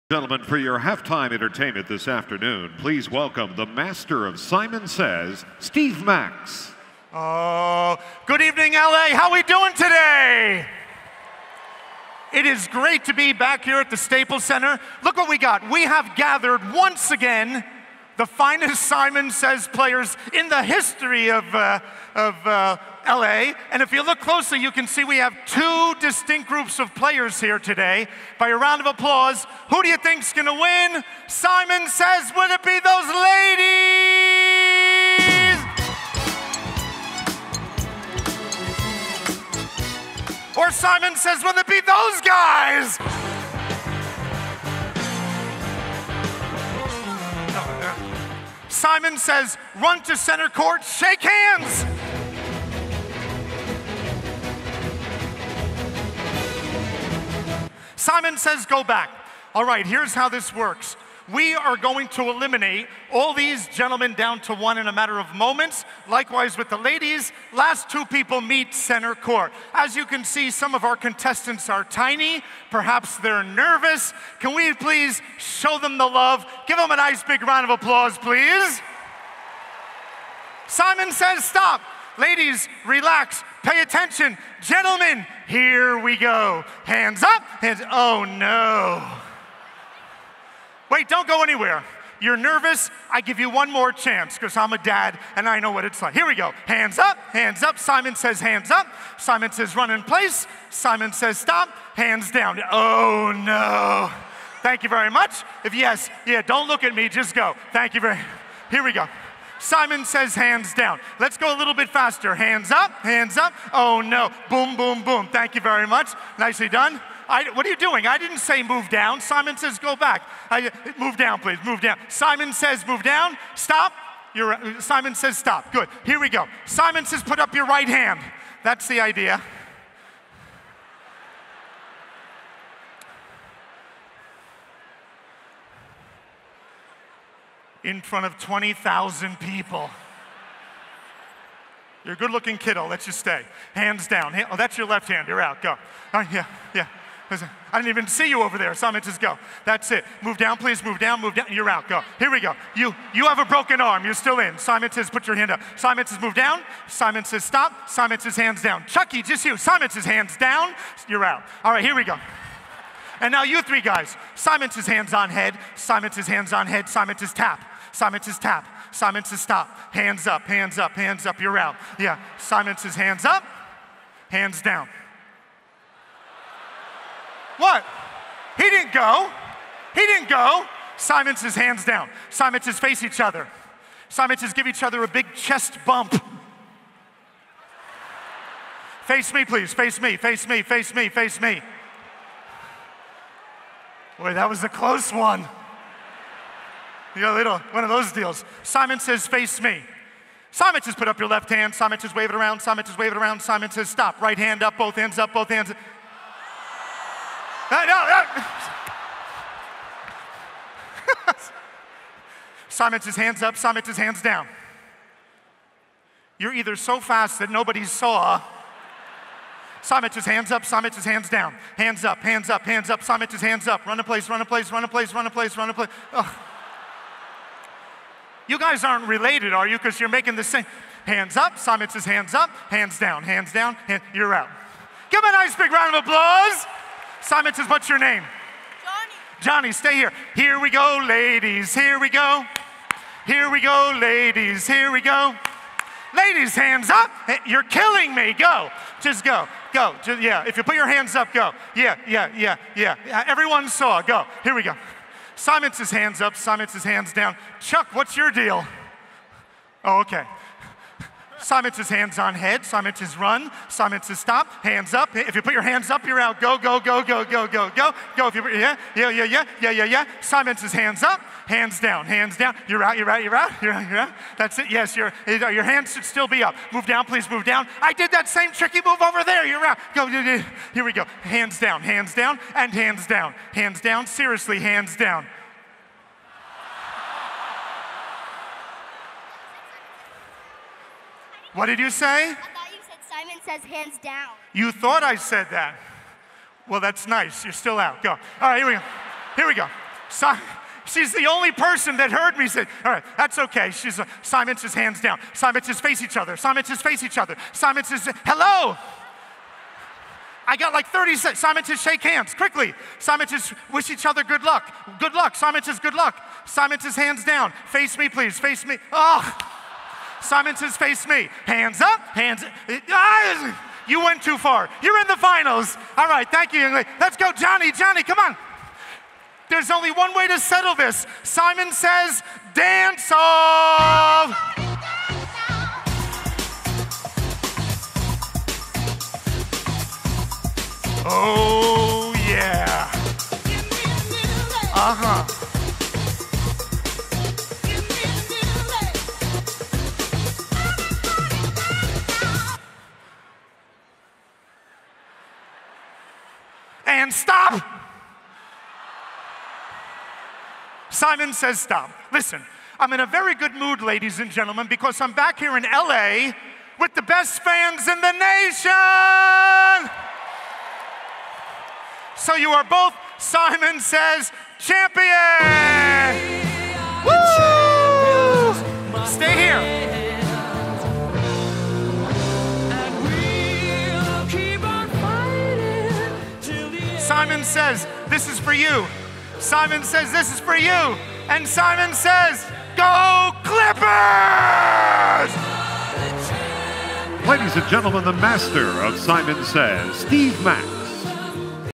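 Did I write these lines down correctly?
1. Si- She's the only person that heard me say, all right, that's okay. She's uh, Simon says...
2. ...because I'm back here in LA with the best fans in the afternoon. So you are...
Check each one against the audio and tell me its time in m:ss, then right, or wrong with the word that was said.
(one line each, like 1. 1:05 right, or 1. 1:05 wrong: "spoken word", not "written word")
1. 5:00 right
2. 6:04 wrong: "nation", not "afternoon".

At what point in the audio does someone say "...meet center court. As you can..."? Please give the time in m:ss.
1:08.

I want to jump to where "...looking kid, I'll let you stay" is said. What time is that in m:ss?
2:22.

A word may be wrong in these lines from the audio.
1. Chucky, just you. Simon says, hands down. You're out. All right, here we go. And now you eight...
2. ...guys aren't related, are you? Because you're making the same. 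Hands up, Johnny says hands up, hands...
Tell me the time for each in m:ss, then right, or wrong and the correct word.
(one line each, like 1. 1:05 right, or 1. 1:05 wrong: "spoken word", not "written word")
1. 2:38 wrong: "three", not "eight"
2. 3:48 wrong: "Simon", not "Johnny".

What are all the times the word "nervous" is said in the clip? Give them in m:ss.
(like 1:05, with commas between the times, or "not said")
1:13, 1:32.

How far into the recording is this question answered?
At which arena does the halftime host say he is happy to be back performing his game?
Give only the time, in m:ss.
0:13.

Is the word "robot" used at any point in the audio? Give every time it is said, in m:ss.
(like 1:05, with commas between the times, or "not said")
not said.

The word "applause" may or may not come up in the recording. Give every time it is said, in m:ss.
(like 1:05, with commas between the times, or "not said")
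0:28, 1:17, 3:56.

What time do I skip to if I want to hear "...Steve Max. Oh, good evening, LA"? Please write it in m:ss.
0:05.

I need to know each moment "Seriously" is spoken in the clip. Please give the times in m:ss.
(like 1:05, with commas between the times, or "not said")
4:44.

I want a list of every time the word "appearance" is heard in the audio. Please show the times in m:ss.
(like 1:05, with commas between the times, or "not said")
not said.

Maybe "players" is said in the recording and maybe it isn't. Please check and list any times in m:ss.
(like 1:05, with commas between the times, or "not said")
0:19, 0:26.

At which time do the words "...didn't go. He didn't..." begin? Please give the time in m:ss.
2:58.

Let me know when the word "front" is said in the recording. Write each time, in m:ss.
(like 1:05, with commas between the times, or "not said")
2:17.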